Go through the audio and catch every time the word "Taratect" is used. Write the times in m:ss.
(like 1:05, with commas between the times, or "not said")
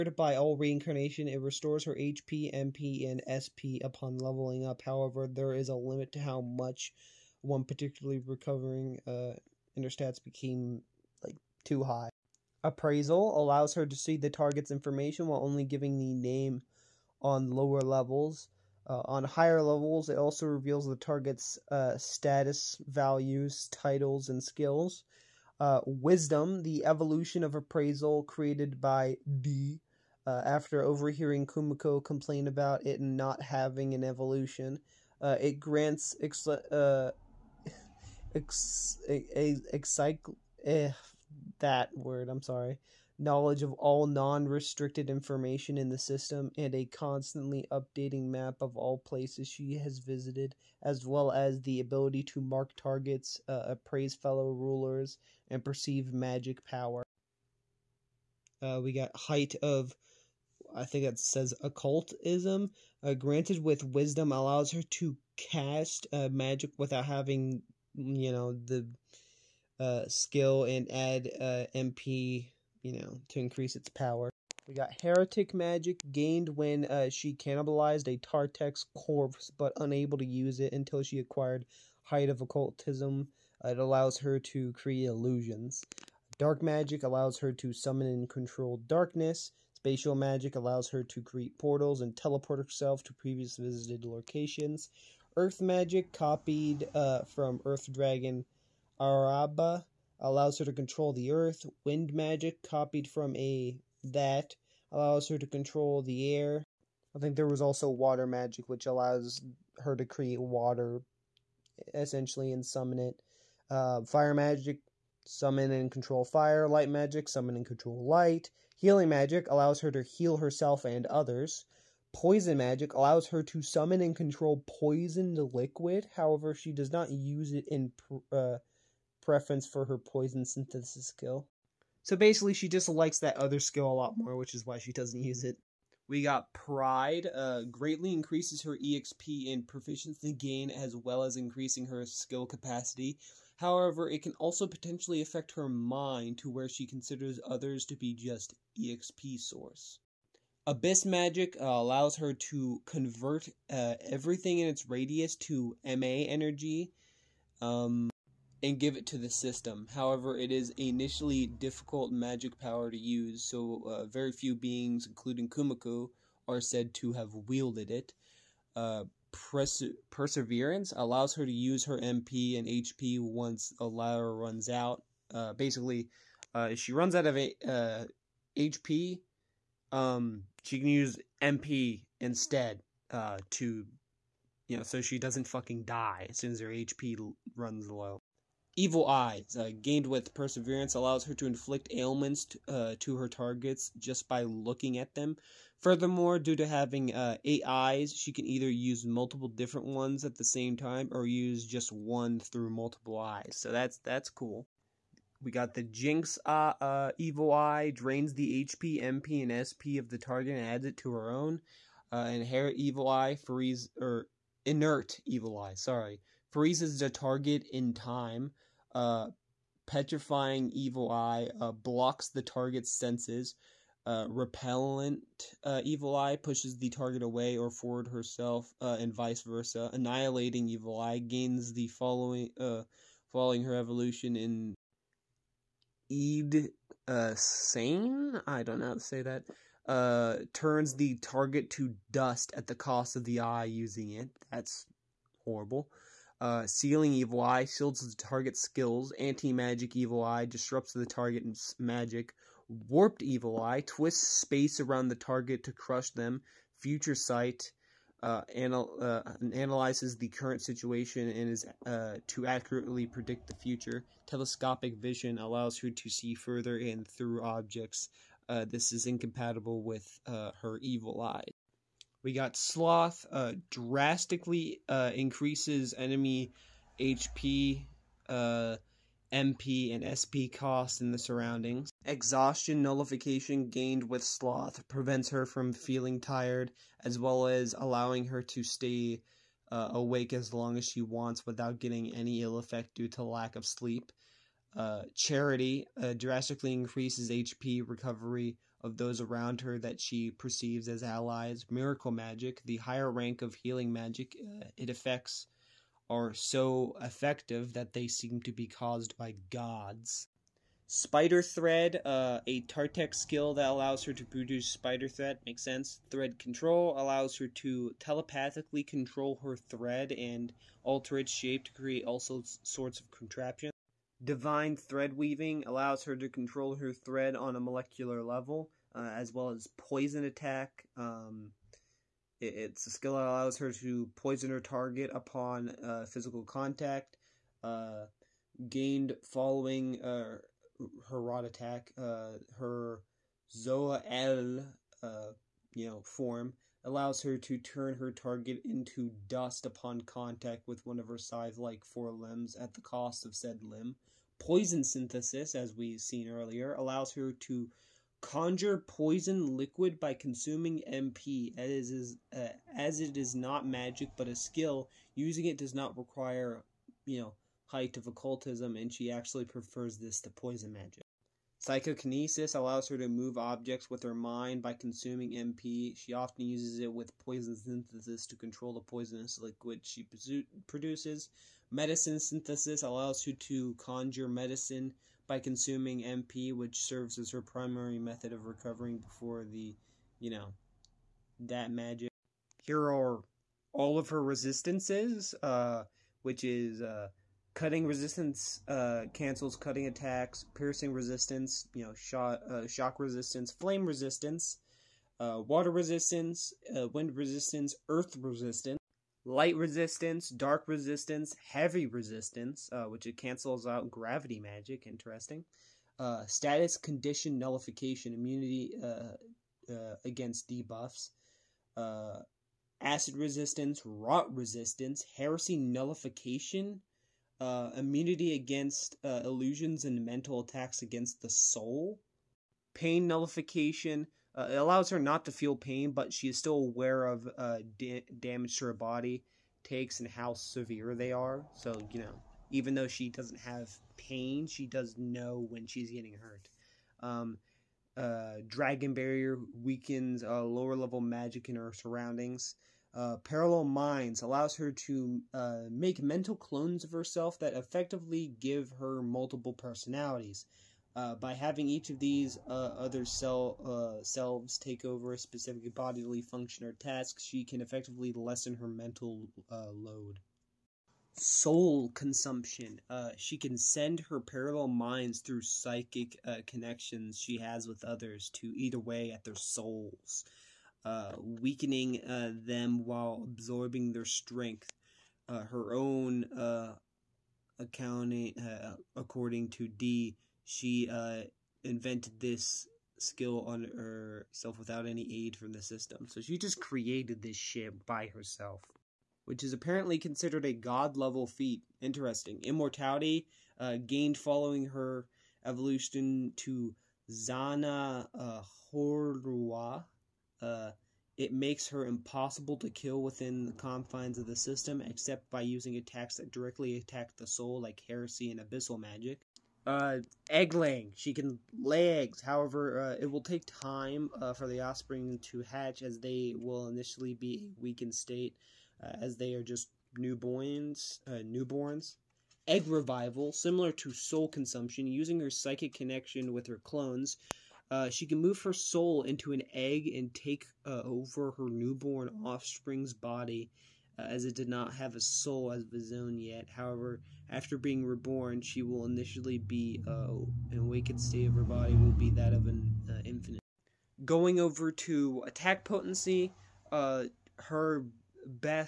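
1:18, 5:12.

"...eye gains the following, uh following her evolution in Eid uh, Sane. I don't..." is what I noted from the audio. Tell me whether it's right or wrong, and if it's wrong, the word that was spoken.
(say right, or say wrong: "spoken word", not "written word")
right.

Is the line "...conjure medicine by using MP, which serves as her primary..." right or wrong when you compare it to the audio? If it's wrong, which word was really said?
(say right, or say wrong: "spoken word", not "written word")
wrong: "consuming", not "using".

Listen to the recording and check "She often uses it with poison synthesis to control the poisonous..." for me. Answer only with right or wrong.
right.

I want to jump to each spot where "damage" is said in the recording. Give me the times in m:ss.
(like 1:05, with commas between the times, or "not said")
7:18.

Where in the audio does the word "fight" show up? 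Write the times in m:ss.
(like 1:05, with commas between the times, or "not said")
not said.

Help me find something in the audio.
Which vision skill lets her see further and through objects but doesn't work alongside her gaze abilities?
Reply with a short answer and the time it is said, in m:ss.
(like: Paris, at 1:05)
Telescopic vision, at 4:24.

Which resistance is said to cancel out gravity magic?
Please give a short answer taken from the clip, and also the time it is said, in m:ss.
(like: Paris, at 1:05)
Heavy resistance, at 6:51.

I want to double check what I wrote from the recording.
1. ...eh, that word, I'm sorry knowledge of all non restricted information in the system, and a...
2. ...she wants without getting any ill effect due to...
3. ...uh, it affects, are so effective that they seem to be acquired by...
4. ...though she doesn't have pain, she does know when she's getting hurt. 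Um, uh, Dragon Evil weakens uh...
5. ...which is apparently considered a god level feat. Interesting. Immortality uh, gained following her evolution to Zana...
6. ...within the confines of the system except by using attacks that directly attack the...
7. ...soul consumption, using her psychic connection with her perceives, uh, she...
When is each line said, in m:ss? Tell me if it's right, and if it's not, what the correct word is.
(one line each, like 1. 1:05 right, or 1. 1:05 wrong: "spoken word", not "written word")
1. 0:40 right
2. 4:50 right
3. 5:04 wrong: "caused", not "acquired"
4. 7:22 wrong: "Barrier", not "Evil"
5. 8:19 right
6. 8:33 right
7. 8:53 wrong: "clones", not "perceives".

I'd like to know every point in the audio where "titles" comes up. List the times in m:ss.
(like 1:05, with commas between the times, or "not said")
0:23.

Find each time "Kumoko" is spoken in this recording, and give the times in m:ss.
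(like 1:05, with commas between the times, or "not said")
0:31, 2:45.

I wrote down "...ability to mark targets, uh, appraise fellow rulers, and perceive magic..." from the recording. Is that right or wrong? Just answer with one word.
right.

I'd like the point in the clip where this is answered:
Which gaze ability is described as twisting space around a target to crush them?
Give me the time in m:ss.
4:12.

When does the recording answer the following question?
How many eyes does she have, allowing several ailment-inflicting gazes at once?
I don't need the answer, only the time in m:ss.
3:17.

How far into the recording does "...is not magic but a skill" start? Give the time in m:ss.
6:03.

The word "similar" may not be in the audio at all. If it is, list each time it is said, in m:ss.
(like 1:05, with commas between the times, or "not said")
8:53.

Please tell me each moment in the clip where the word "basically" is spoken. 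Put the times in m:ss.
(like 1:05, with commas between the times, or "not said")
2:12, 2:55.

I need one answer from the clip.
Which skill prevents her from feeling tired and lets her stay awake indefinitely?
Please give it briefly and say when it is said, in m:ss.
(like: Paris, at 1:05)
Exhaustion nullification, at 4:42.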